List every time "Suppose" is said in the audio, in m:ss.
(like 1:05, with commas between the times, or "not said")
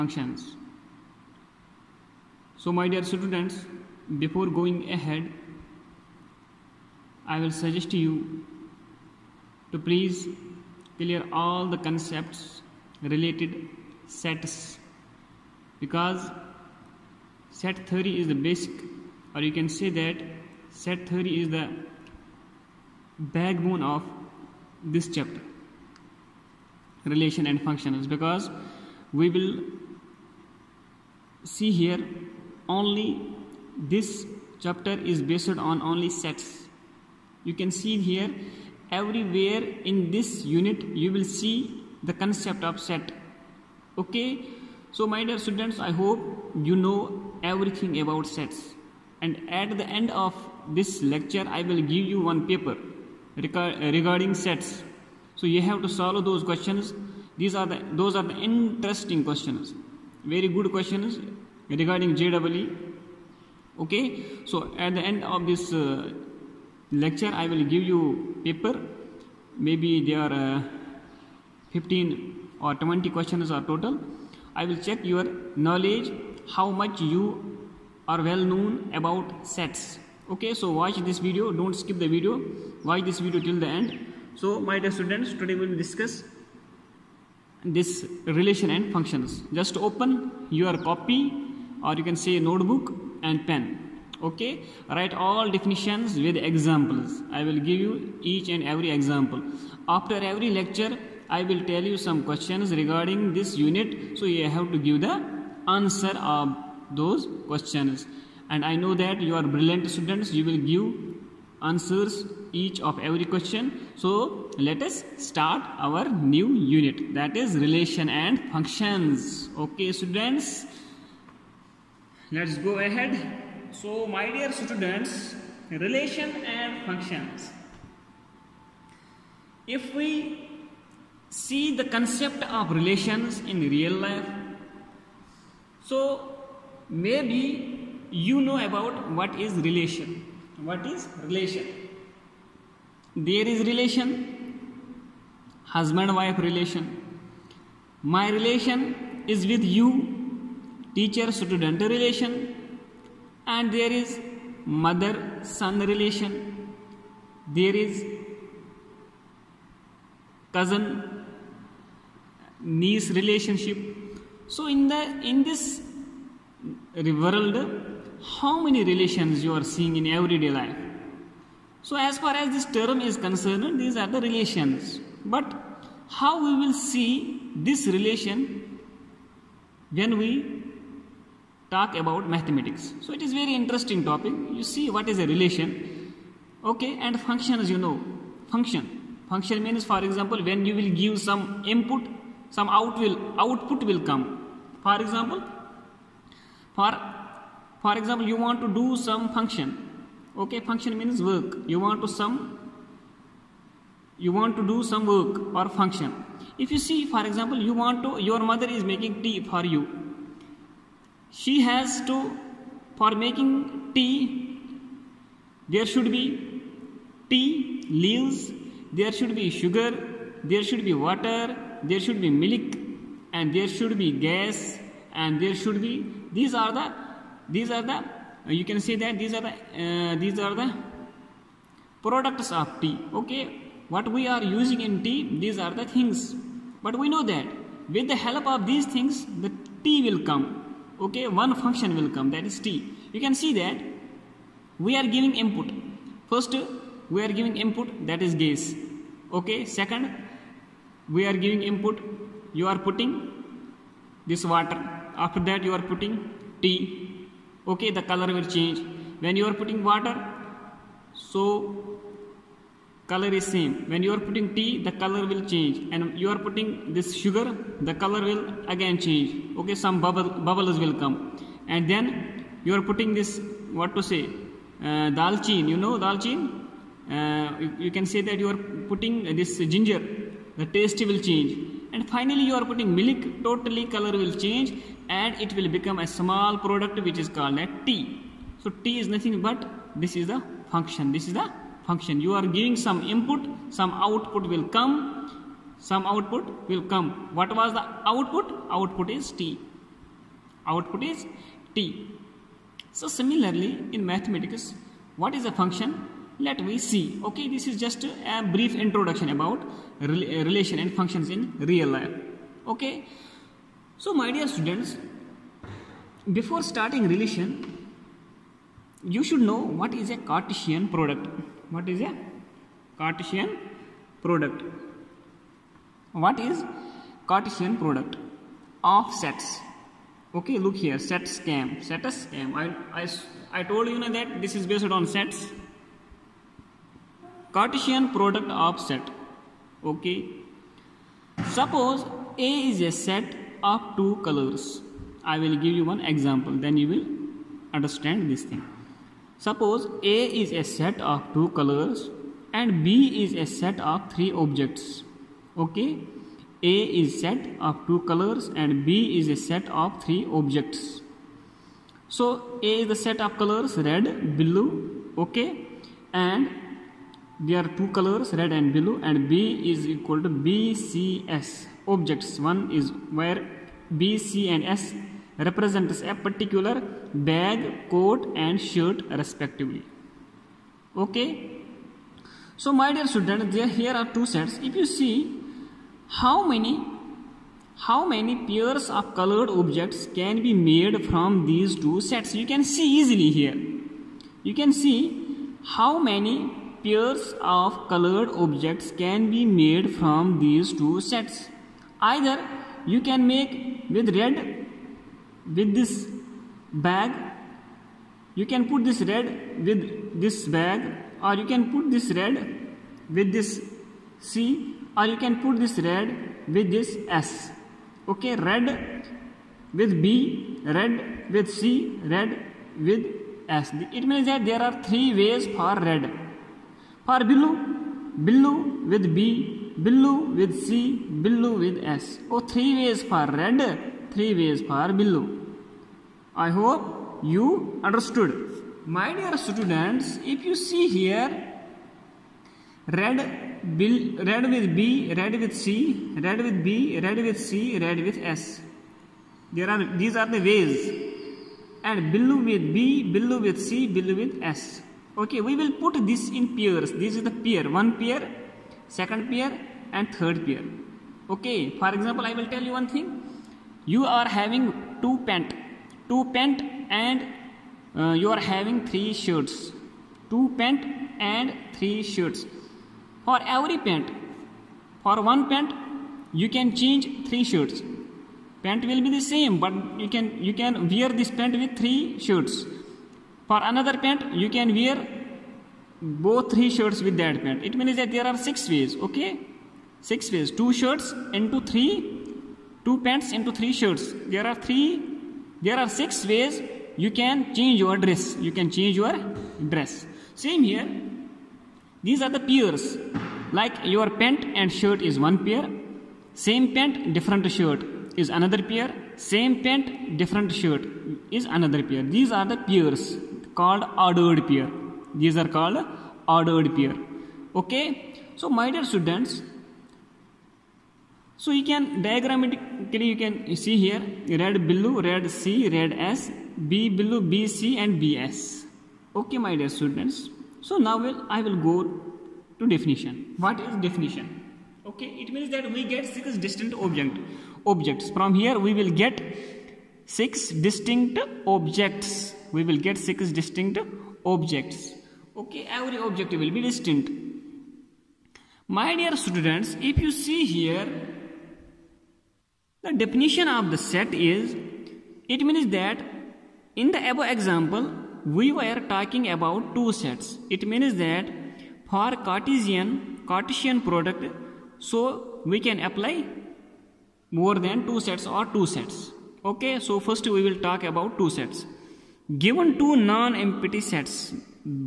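5:41, 5:49.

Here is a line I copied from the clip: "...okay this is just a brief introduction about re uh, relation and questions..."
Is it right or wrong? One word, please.
wrong.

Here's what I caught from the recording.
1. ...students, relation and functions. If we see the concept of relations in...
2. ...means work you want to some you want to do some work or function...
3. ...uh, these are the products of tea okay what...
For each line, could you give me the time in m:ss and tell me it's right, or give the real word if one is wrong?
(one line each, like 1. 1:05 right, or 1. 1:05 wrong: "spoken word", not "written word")
1. 2:04 right
2. 3:21 right
3. 3:49 right.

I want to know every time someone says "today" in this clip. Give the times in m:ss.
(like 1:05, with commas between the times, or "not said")
1:25.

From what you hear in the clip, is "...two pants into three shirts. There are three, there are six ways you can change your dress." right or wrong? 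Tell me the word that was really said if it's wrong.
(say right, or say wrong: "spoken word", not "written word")
right.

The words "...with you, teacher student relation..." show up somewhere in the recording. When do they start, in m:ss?
2:29.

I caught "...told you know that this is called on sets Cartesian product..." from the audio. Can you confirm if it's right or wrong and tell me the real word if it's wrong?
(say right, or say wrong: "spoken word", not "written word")
wrong: "based", not "called".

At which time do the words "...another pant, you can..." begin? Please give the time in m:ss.
8:03.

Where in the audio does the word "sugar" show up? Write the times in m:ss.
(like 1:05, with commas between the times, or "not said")
3:39, 4:27.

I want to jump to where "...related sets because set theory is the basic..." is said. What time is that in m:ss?
0:13.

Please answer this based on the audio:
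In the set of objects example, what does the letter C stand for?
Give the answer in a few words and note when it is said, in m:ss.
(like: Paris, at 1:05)
coat, at 6:17.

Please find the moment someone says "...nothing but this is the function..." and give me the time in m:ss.
4:49.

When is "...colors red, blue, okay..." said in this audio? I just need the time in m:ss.
6:03.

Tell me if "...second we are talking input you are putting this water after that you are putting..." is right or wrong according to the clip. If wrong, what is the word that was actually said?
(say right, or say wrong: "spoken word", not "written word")
wrong: "giving", not "talking".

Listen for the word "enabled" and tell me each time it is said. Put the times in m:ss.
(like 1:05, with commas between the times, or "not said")
not said.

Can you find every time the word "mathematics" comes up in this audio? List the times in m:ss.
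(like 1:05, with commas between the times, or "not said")
3:02, 5:04.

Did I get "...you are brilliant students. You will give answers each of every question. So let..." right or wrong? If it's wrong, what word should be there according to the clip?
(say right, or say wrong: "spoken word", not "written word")
right.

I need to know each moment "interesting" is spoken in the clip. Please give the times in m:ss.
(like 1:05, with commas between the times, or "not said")
0:58, 3:03.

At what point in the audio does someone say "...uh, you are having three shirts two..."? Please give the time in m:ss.
7:47.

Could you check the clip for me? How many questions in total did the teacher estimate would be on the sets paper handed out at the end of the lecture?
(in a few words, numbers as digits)
15 or 20.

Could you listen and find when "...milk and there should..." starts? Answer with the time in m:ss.
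3:42.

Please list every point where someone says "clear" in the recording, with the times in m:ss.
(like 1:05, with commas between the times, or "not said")
0:10.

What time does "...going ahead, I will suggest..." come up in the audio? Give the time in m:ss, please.
0:04.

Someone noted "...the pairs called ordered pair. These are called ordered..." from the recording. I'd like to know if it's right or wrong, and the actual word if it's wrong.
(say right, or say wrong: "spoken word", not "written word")
right.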